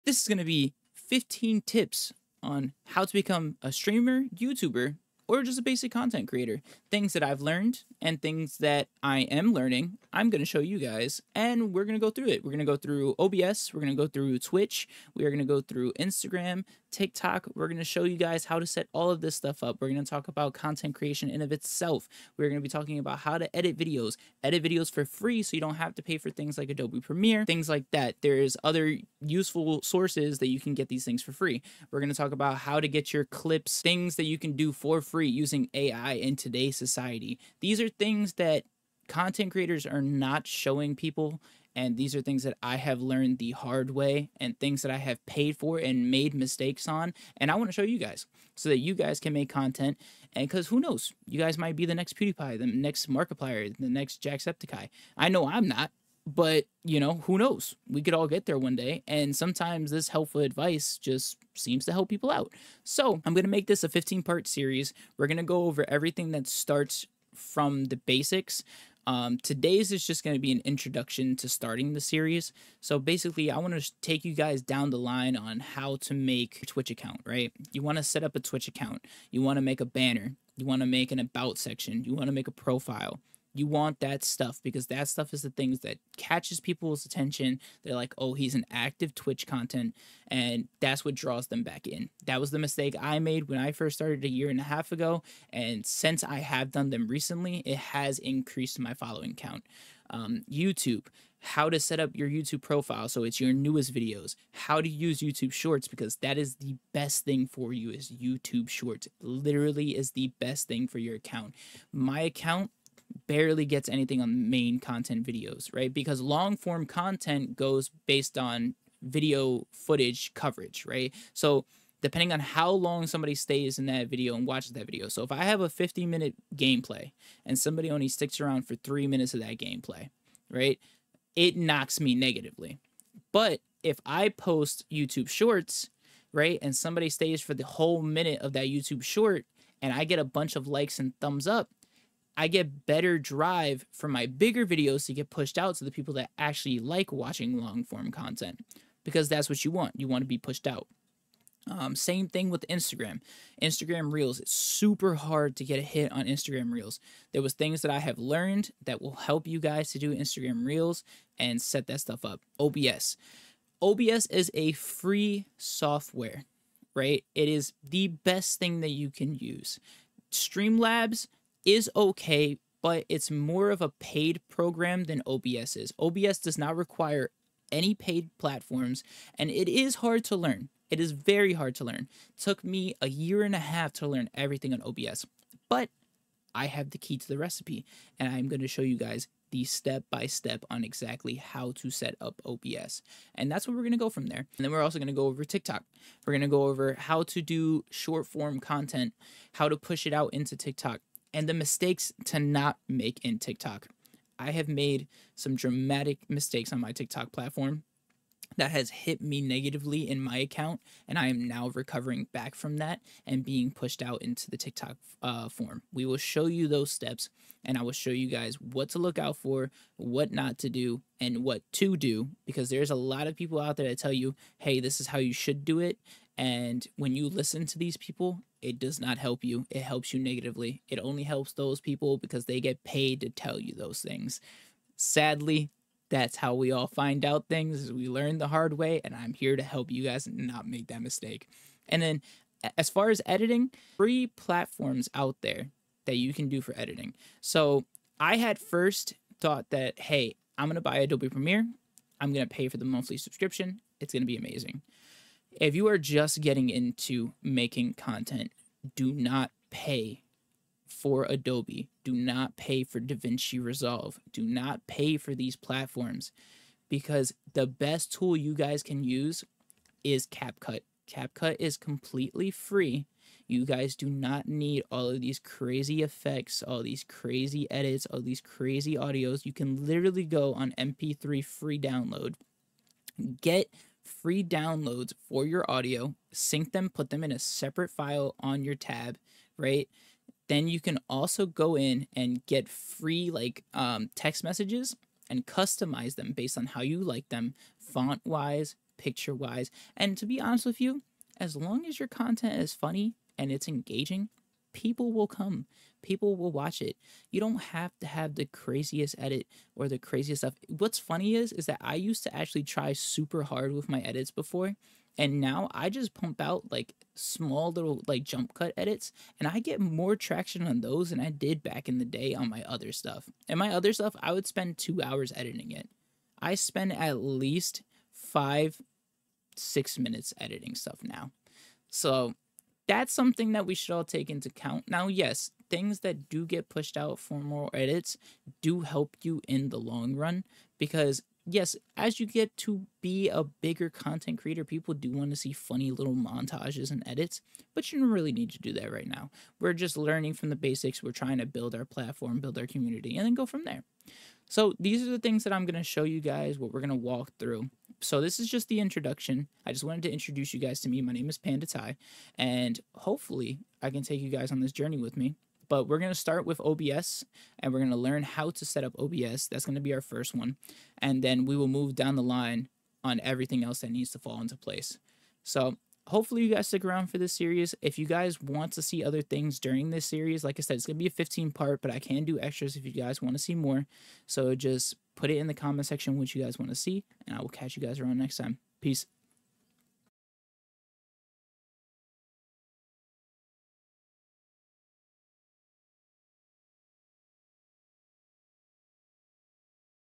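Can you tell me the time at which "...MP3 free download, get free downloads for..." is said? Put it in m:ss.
4:40.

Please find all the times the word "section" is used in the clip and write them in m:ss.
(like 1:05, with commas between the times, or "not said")
1:21, 6:25.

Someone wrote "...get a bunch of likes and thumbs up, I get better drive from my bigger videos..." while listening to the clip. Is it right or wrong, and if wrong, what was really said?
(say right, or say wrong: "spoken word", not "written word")
right.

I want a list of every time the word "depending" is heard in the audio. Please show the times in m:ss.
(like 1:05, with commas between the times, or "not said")
2:02.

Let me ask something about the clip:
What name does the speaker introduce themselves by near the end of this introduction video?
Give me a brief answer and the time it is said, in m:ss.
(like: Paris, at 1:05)
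Pandaty, at 6:01.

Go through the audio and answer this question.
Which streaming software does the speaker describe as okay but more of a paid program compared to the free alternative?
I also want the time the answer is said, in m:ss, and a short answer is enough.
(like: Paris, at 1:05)
Streamlabs, at 2:50.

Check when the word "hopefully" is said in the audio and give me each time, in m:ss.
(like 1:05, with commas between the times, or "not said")
6:02, 6:16.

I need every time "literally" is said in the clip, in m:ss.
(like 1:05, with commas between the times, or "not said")
1:49, 4:39.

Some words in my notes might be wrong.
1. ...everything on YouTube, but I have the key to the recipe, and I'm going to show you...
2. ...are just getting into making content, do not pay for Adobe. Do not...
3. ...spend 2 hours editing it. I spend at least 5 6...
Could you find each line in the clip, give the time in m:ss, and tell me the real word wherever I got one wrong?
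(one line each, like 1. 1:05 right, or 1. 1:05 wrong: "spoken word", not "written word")
1. 3:04 wrong: "OBS", not "YouTube"
2. 4:15 right
3. 5:24 right.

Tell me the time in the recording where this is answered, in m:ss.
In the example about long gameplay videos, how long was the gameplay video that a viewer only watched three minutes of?
2:05.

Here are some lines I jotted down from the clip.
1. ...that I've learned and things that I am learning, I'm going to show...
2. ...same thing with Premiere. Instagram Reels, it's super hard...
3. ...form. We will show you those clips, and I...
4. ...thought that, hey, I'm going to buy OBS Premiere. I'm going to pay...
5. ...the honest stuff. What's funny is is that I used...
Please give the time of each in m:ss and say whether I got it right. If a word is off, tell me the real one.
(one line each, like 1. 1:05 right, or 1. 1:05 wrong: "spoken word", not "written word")
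1. 0:07 right
2. 2:31 wrong: "Instagram", not "Premiere"
3. 3:35 wrong: "steps", not "clips"
4. 4:09 wrong: "Adobe", not "OBS"
5. 5:09 wrong: "craziest", not "honest".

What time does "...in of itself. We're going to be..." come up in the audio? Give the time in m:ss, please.
0:21.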